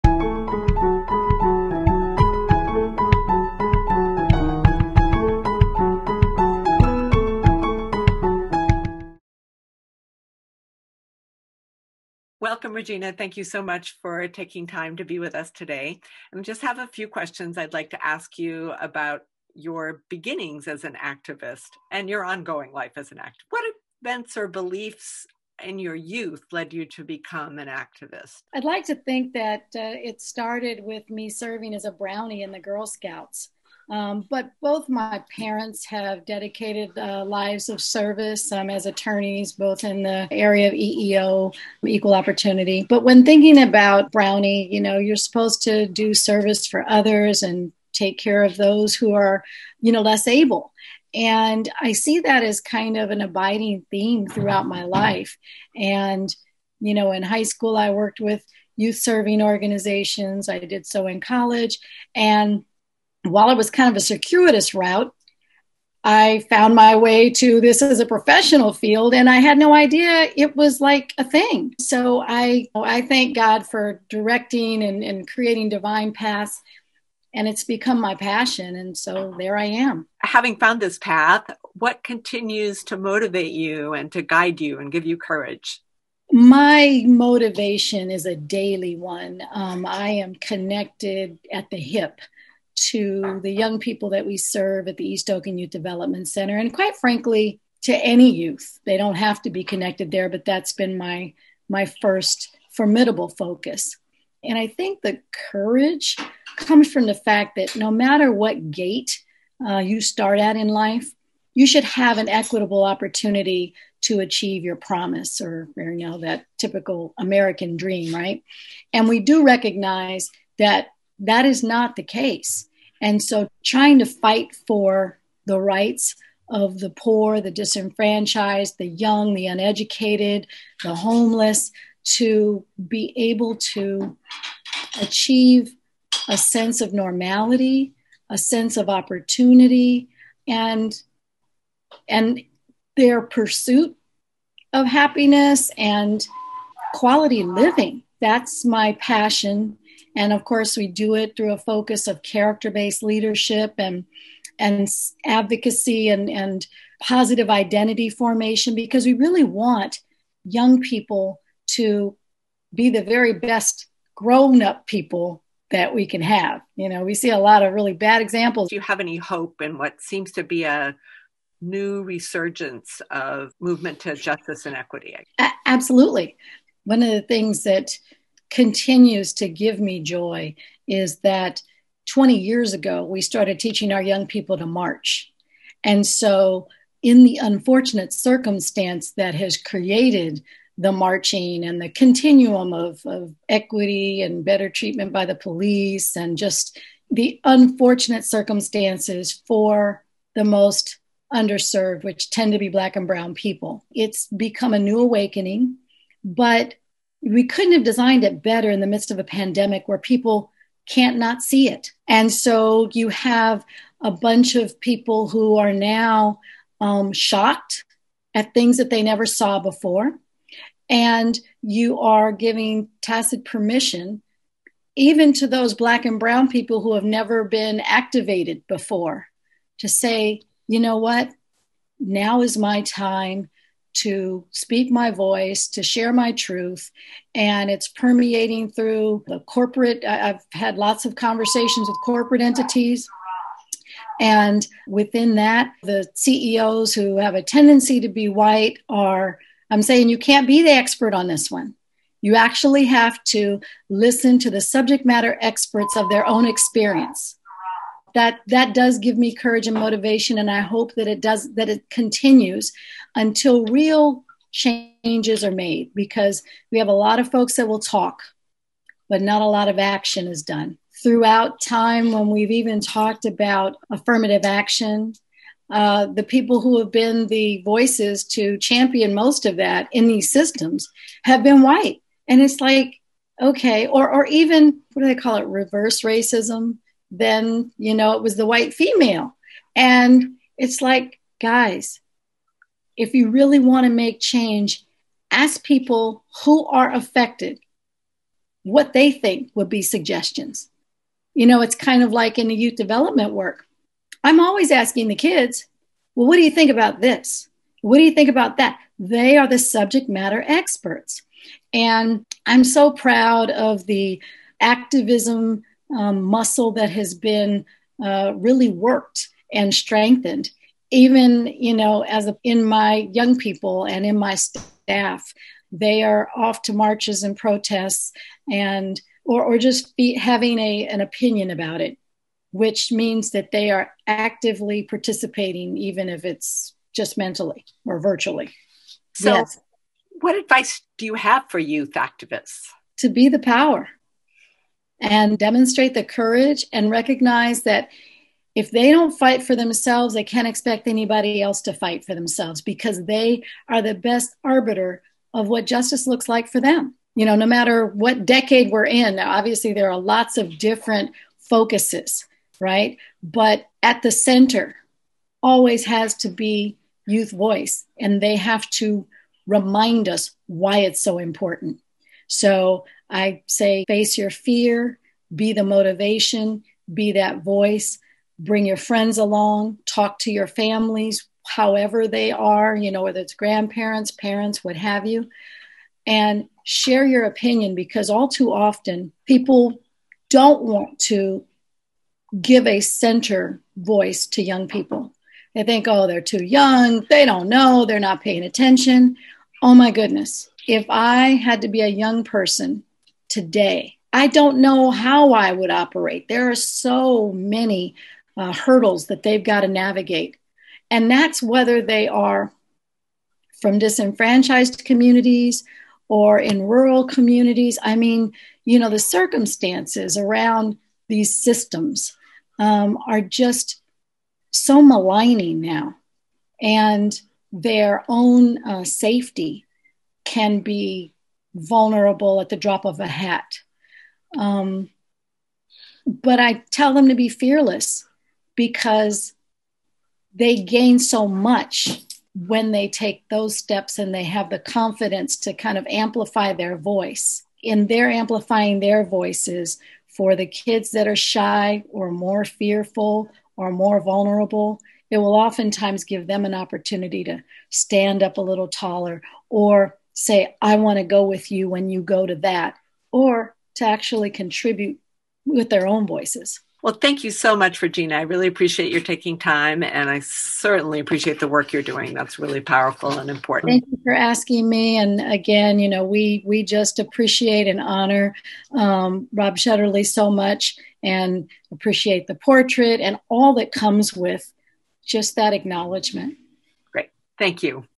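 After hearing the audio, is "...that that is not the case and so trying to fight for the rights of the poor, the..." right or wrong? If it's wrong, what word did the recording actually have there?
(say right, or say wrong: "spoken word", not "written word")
right.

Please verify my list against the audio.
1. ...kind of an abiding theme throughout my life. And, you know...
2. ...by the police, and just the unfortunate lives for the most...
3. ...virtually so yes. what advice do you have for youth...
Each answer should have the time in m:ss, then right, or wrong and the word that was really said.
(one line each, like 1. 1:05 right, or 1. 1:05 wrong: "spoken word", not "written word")
1. 0:52 right
2. 3:15 wrong: "circumstances", not "lives"
3. 5:37 right.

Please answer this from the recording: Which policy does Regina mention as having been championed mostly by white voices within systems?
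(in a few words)
Affirmative action.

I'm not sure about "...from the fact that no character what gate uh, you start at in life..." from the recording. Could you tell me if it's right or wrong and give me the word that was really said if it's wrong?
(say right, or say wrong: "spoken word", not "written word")
wrong: "matter", not "character".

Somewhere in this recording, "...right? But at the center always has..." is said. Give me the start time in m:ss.
6:02.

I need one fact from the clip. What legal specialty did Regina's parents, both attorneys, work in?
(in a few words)
EEO, equal opportunity.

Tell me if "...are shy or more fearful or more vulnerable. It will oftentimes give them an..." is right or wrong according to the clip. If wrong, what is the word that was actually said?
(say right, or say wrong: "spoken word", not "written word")
right.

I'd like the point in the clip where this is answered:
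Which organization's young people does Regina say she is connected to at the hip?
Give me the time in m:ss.
1:35.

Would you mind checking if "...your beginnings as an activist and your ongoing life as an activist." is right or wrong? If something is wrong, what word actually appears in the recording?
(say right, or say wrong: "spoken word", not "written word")
right.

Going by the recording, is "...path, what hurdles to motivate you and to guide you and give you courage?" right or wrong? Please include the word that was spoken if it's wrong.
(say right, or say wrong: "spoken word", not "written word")
wrong: "continues", not "hurdles".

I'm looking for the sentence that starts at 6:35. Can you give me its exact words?
They think, oh, they're too young, they don't know, they're not paying attention.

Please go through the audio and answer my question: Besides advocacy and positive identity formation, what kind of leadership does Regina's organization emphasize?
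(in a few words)
Character based leadership.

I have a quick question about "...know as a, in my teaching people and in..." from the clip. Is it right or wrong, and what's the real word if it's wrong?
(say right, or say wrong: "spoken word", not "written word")
wrong: "young", not "teaching".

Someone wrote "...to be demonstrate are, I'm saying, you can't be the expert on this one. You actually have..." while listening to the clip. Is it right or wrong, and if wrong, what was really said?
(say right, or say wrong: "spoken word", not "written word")
wrong: "white", not "demonstrate".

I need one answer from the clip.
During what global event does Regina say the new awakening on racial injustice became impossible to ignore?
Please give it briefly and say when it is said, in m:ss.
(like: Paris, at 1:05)
A pandemic, at 3:29.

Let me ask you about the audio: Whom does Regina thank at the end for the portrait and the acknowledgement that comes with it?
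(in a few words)
Rob Shetterly.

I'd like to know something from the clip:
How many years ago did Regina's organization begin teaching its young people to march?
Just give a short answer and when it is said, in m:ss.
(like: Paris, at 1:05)
20, at 3:02.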